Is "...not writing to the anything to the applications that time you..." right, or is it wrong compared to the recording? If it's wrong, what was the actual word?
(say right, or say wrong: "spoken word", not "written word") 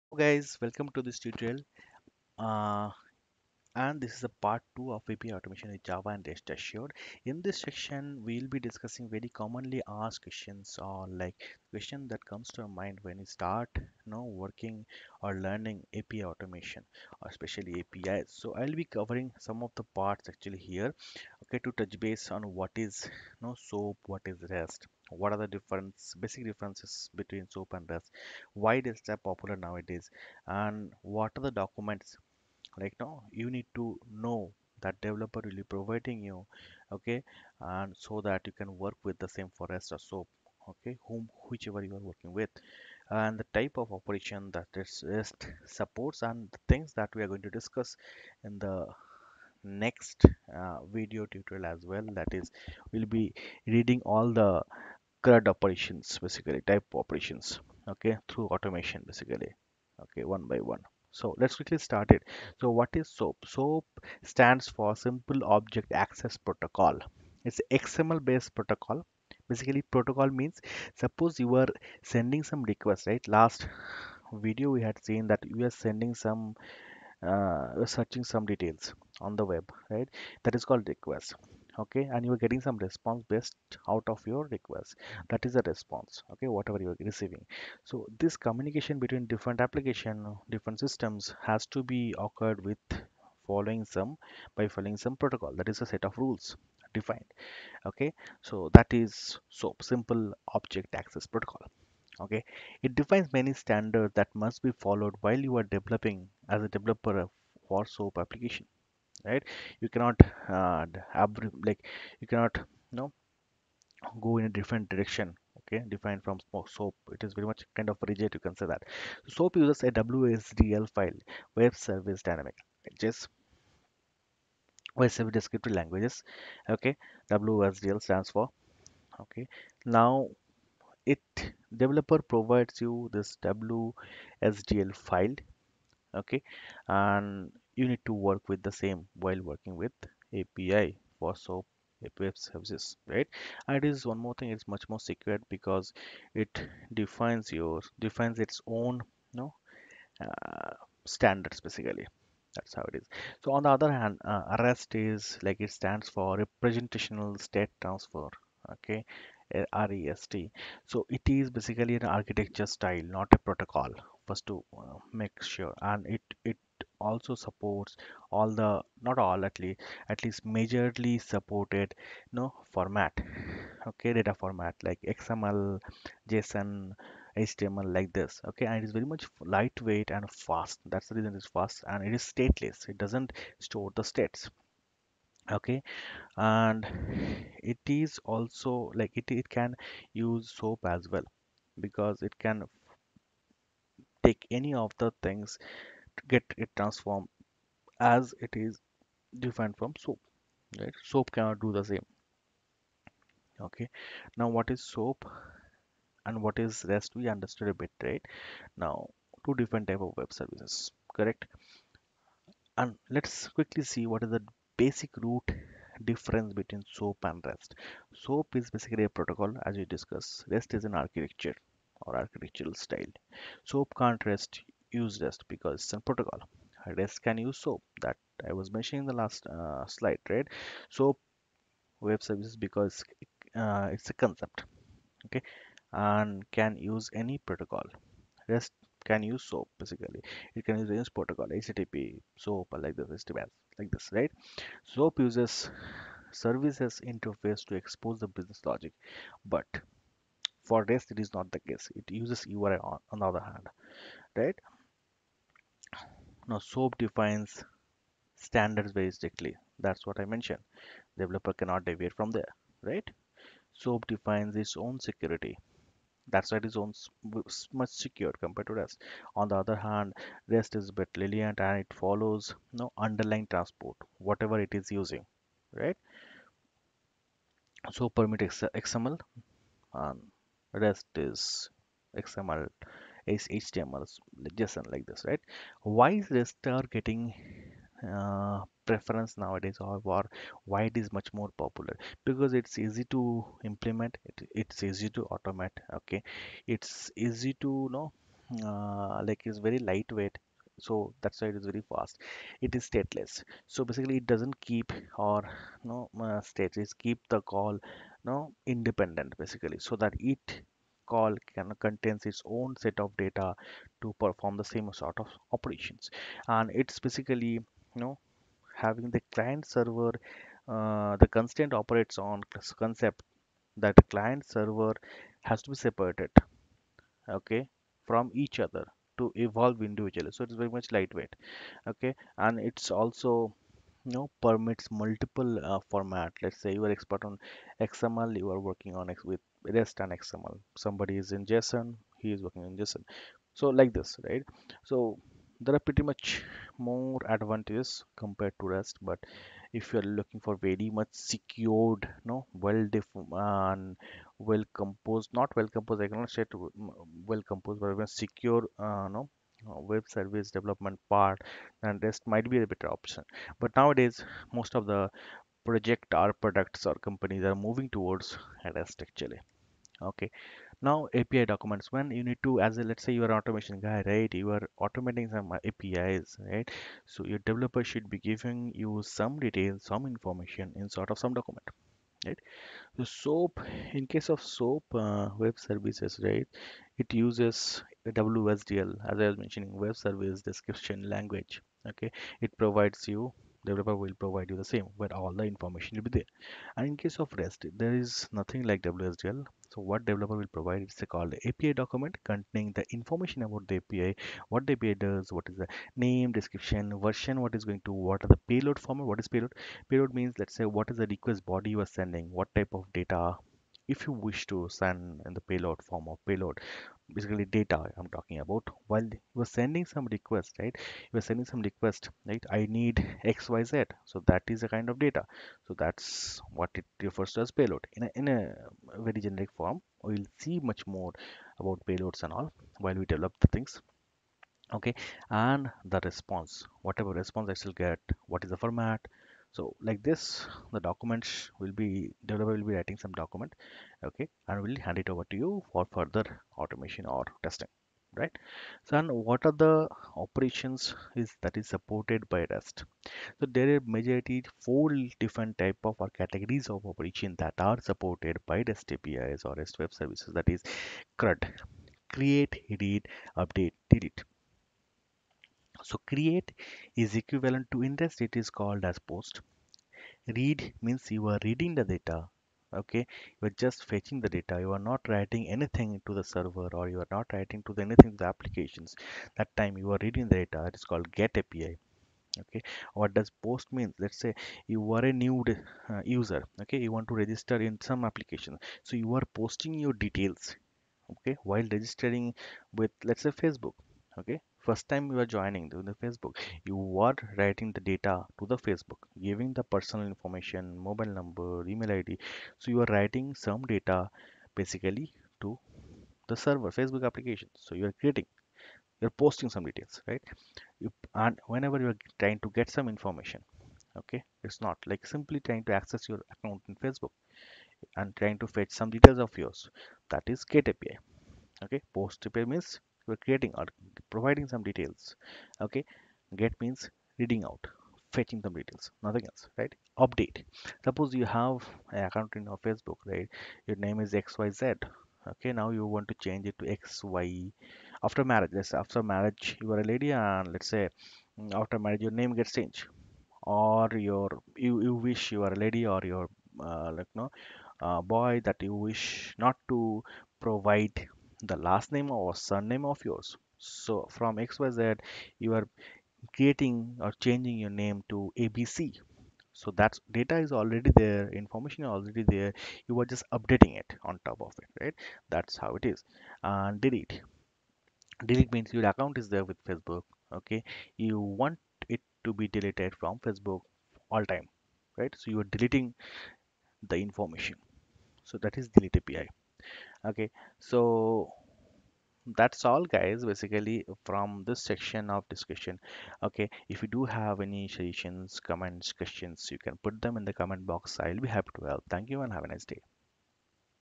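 right.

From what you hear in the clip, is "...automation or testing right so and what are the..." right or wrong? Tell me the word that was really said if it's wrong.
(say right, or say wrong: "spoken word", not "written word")
right.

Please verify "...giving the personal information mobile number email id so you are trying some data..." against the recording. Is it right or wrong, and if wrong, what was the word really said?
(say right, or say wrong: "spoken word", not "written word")
wrong: "writing", not "trying".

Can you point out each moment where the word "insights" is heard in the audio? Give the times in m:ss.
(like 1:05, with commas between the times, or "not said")
not said.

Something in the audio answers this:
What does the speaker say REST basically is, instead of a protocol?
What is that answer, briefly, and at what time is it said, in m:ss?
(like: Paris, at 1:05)
An architecture style, at 2:42.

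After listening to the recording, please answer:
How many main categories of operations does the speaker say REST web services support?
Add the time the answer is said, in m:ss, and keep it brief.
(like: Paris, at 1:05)
4, at 7:34.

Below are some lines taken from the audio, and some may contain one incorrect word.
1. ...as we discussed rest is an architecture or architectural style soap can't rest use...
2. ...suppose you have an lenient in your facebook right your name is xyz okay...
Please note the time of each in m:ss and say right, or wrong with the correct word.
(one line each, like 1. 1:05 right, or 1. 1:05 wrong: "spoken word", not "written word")
1. 3:39 right
2. 8:50 wrong: "account", not "lenient".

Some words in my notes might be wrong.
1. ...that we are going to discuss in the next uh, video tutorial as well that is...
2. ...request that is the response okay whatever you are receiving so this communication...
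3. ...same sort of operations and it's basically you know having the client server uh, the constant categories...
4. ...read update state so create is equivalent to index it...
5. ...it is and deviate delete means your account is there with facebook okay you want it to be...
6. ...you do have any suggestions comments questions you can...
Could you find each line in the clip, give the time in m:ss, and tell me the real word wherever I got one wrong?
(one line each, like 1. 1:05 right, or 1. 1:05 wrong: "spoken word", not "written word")
1. 0:46 right
2. 1:24 right
3. 5:14 wrong: "operates", not "categories"
4. 7:42 wrong: "delete", not "state"
5. 9:25 wrong: "delete", not "deviate"
6. 9:46 right.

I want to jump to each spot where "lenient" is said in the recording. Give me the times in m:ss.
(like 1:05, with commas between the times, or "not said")
4:31.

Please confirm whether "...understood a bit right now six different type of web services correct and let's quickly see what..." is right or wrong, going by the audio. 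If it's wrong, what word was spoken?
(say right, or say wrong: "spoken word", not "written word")
wrong: "two", not "six".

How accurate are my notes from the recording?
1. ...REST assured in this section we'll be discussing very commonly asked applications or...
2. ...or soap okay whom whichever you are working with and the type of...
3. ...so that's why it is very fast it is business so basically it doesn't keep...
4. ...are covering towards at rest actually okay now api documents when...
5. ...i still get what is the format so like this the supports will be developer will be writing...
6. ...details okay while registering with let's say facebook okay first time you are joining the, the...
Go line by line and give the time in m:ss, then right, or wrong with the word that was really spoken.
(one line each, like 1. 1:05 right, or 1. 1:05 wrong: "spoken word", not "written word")
1. 0:06 wrong: "questions", not "applications"
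2. 0:39 right
3. 5:00 wrong: "stateless", not "business"
4. 6:07 wrong: "moving", not "covering"
5. 7:17 wrong: "documents", not "supports"
6. 8:10 right.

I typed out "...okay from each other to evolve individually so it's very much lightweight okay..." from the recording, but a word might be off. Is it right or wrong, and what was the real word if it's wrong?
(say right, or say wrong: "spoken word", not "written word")
right.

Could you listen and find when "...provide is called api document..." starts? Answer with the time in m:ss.
6:40.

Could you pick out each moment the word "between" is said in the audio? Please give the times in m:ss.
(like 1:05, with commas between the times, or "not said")
0:27, 1:28, 3:36.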